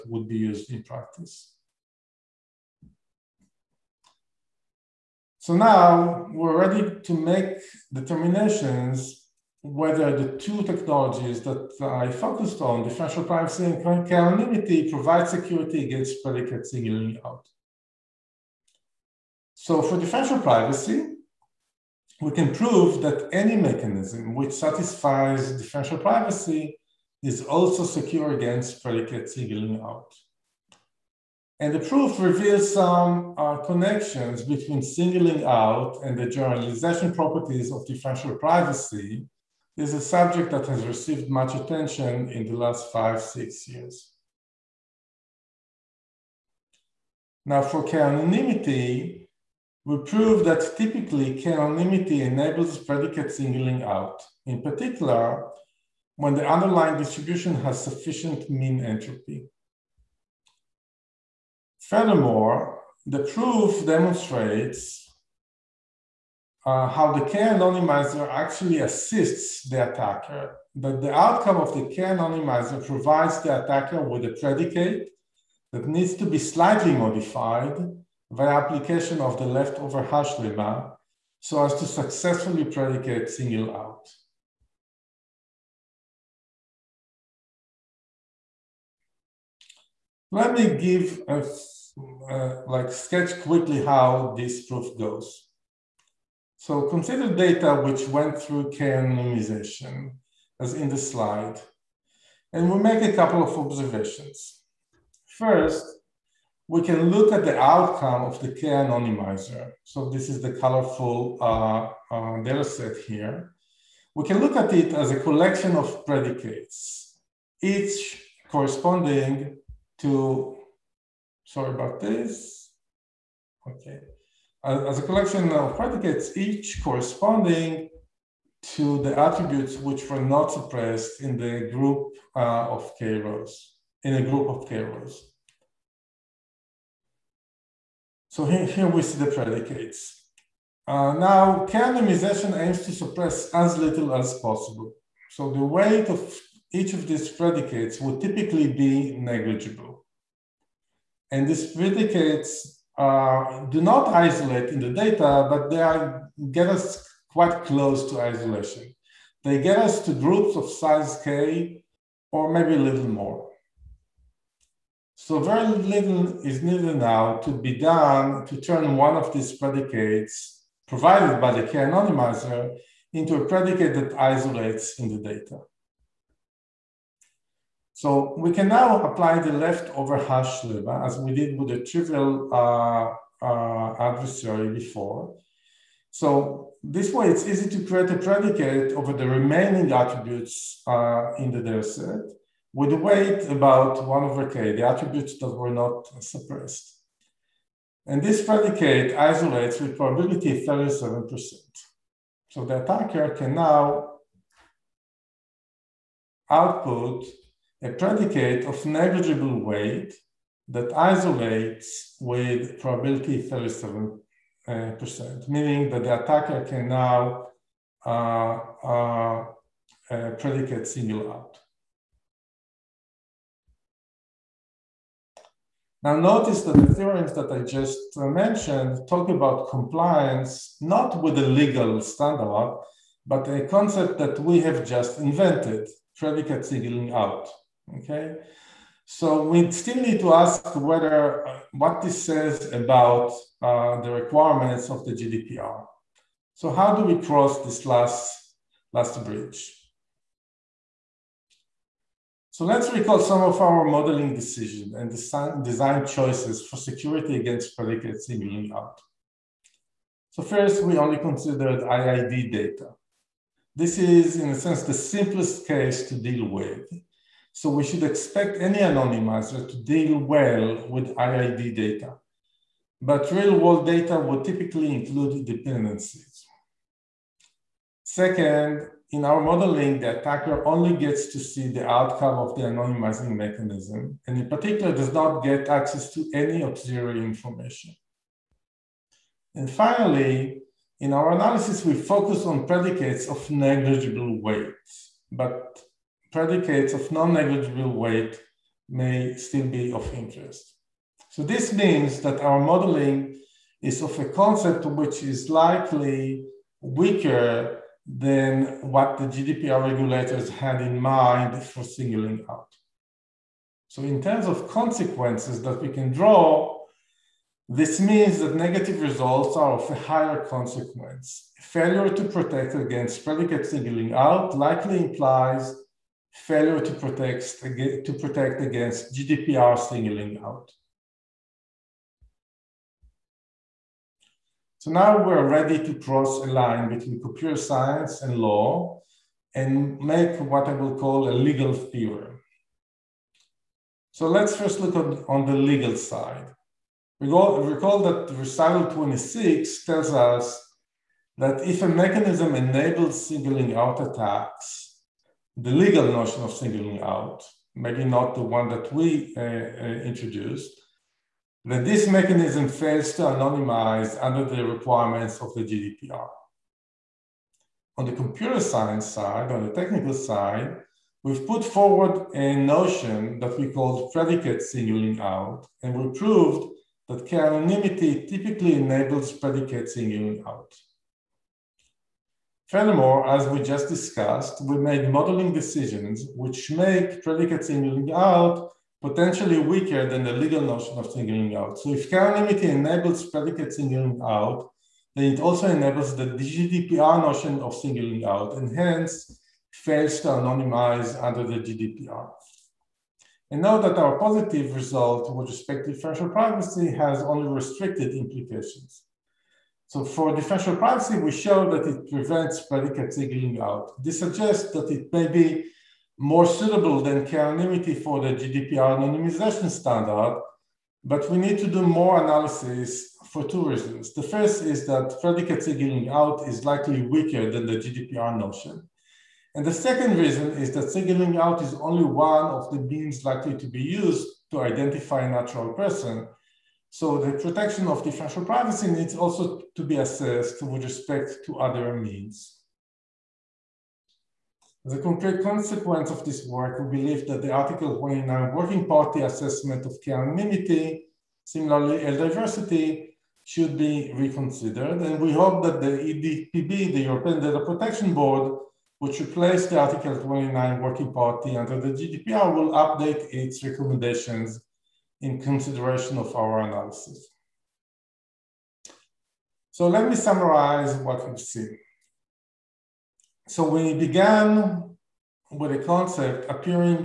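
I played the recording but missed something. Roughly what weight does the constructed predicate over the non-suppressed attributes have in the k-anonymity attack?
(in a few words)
1 over k.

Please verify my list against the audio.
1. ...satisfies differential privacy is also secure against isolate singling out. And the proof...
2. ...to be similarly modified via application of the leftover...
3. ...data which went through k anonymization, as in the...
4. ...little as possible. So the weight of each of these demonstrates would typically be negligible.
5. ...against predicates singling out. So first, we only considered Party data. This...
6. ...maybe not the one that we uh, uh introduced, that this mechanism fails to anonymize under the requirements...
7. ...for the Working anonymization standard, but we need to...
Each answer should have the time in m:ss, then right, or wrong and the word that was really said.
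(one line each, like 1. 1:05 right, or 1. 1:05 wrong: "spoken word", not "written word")
1. 0:24 wrong: "predicate", not "isolate"
2. 1:16 wrong: "slightly", not "similarly"
3. 1:37 right
4. 2:23 wrong: "predicates", not "demonstrates"
5. 4:17 wrong: "IID", not "Party"
6. 5:57 right
7. 6:57 wrong: "GDPR", not "Working".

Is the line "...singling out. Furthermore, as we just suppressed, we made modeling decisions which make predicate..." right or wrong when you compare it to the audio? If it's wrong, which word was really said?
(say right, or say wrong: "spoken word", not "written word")
wrong: "discussed", not "suppressed".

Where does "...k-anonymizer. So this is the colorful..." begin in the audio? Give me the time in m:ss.
1:48.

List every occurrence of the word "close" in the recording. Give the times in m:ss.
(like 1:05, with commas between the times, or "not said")
2:37.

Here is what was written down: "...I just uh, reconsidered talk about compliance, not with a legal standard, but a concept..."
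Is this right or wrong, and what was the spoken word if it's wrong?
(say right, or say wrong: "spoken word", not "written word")
wrong: "mentioned", not "reconsidered".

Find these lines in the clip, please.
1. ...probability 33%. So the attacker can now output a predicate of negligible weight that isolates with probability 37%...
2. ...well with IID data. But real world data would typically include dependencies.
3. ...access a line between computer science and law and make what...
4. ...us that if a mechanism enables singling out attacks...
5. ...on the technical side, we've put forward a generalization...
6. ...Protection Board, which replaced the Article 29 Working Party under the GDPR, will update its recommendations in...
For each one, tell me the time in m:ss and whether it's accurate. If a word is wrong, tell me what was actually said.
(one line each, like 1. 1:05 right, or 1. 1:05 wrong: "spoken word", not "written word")
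1. 3:19 wrong: "37", not "33"
2. 4:30 right
3. 5:35 wrong: "cross", not "access"
4. 5:50 right
5. 6:09 wrong: "notion", not "generalization"
6. 7:37 right.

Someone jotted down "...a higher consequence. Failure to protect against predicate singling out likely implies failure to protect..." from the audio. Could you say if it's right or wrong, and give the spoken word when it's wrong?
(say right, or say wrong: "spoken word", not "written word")
right.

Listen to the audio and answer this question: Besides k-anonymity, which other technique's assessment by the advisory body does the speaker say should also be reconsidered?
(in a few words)
L diversity.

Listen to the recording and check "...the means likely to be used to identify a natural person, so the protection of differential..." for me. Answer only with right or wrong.
right.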